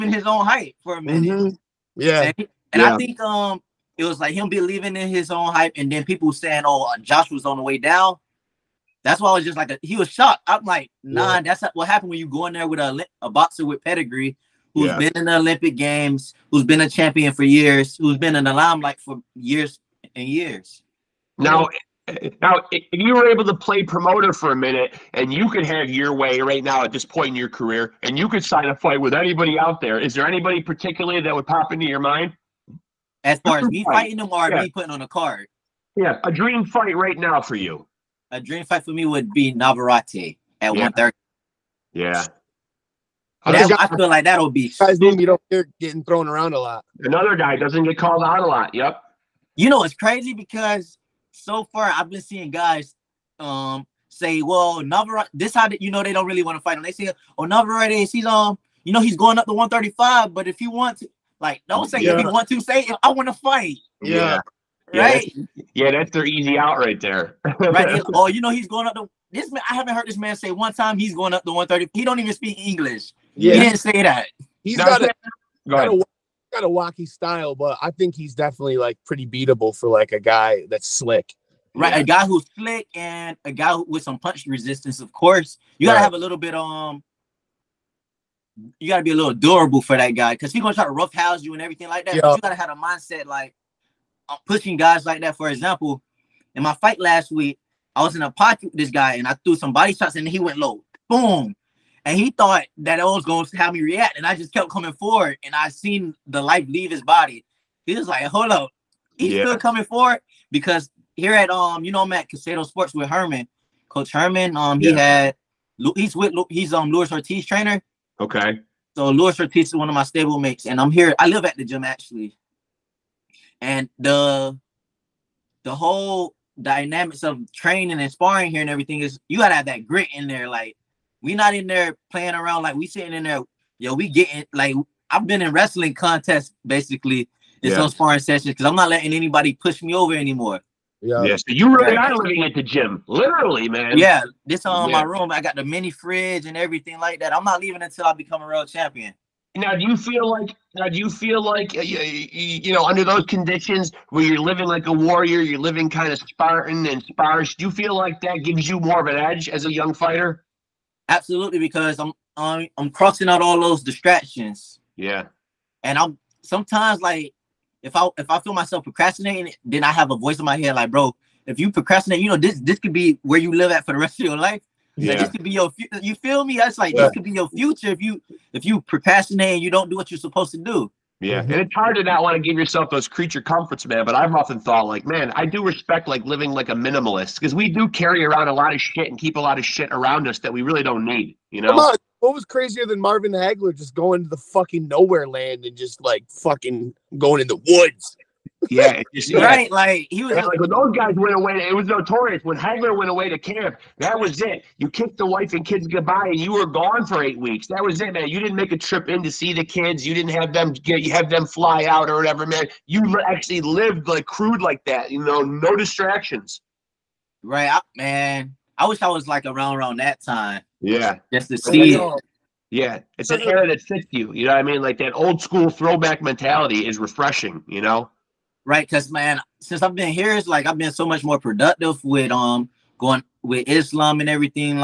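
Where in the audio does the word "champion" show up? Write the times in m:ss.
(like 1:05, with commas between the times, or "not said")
0:16, 2:28.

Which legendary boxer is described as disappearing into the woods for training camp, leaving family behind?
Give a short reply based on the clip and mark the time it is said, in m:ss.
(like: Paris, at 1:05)
Marvin Hagler, at 3:12.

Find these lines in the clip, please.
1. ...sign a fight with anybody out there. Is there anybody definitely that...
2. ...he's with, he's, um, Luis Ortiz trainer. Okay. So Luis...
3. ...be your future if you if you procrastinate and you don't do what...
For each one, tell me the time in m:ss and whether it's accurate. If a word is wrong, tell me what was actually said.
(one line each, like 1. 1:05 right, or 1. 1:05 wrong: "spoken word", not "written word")
1. 0:28 wrong: "particularly", not "definitely"
2. 1:55 right
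3. 2:57 right.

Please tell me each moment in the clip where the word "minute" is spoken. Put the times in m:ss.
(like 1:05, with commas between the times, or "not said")
0:01, 0:24.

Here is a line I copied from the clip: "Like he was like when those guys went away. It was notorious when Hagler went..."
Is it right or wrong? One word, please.
right.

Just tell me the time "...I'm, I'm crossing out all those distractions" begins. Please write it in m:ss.
2:42.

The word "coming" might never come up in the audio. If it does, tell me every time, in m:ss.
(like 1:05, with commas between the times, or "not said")
1:44, 1:49.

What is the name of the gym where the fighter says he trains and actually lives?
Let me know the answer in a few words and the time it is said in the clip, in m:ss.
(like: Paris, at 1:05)
Caicedo Sports, at 1:52.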